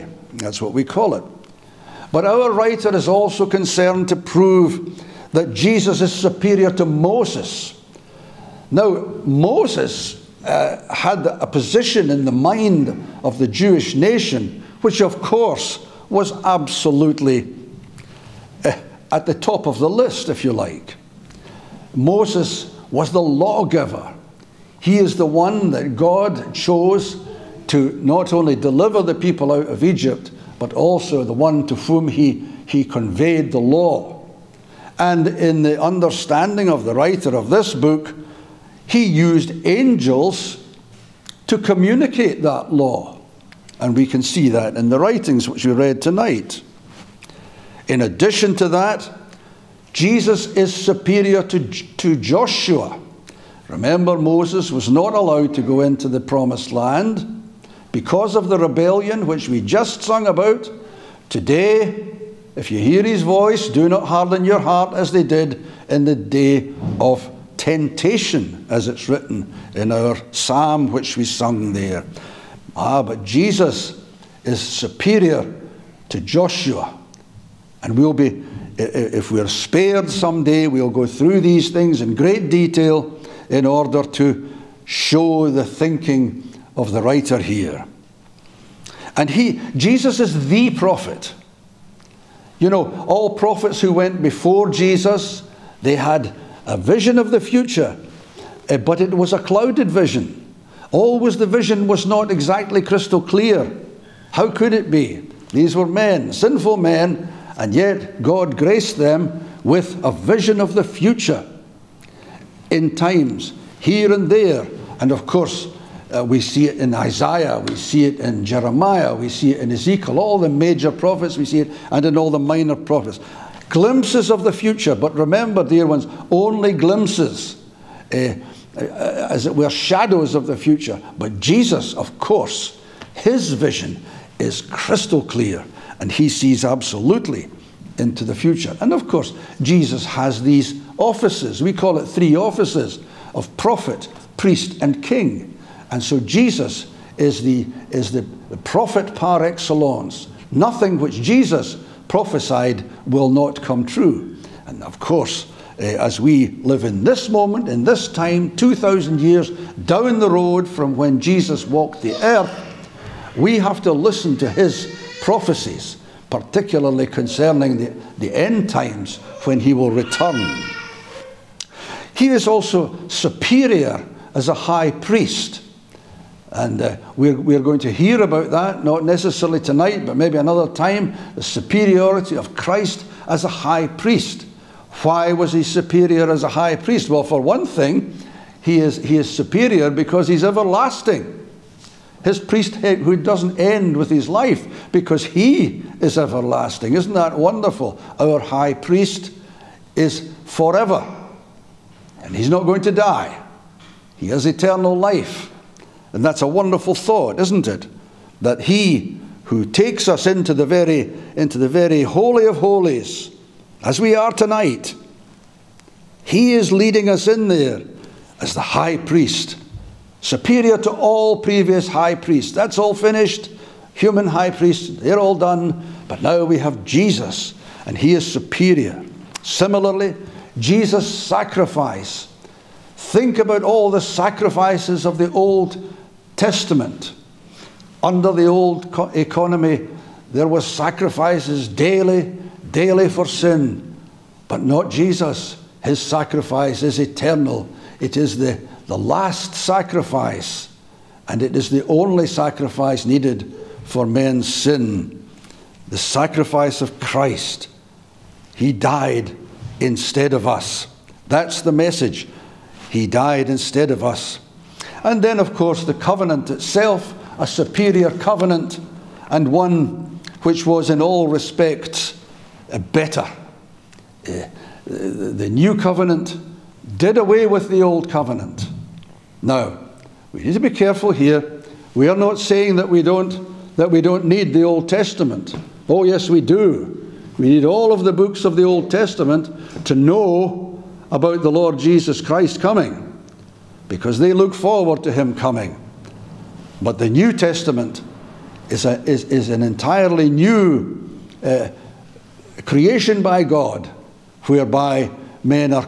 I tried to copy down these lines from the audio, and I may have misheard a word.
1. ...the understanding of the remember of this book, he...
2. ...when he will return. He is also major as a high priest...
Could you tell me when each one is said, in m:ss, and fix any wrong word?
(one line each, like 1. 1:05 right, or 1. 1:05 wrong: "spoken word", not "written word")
1. 0:35 wrong: "writer", not "remember"
2. 2:49 wrong: "superior", not "major".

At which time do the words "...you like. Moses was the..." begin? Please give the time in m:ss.
0:20.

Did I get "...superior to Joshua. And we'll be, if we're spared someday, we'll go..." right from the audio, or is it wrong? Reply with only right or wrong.
right.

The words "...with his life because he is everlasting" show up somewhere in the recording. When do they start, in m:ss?
3:13.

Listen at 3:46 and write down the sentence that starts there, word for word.
But now we have Jesus, and he is superior.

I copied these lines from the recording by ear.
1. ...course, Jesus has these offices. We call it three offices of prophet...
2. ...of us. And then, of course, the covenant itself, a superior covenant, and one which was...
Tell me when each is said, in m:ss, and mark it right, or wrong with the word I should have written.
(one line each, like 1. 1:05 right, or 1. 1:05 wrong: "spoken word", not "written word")
1. 2:19 right
2. 4:23 right.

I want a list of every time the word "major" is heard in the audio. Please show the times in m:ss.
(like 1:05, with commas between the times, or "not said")
2:00.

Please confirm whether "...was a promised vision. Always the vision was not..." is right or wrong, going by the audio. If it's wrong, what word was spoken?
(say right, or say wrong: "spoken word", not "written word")
wrong: "clouded", not "promised".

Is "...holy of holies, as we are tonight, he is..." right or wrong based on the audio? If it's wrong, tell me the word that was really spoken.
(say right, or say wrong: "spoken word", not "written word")
right.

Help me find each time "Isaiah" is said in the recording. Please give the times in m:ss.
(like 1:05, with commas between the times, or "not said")
1:56.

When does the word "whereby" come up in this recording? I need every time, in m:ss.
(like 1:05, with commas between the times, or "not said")
5:04.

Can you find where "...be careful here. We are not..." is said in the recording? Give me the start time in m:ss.
4:40.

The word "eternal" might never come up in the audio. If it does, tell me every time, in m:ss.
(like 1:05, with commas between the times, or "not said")
3:24, 4:06.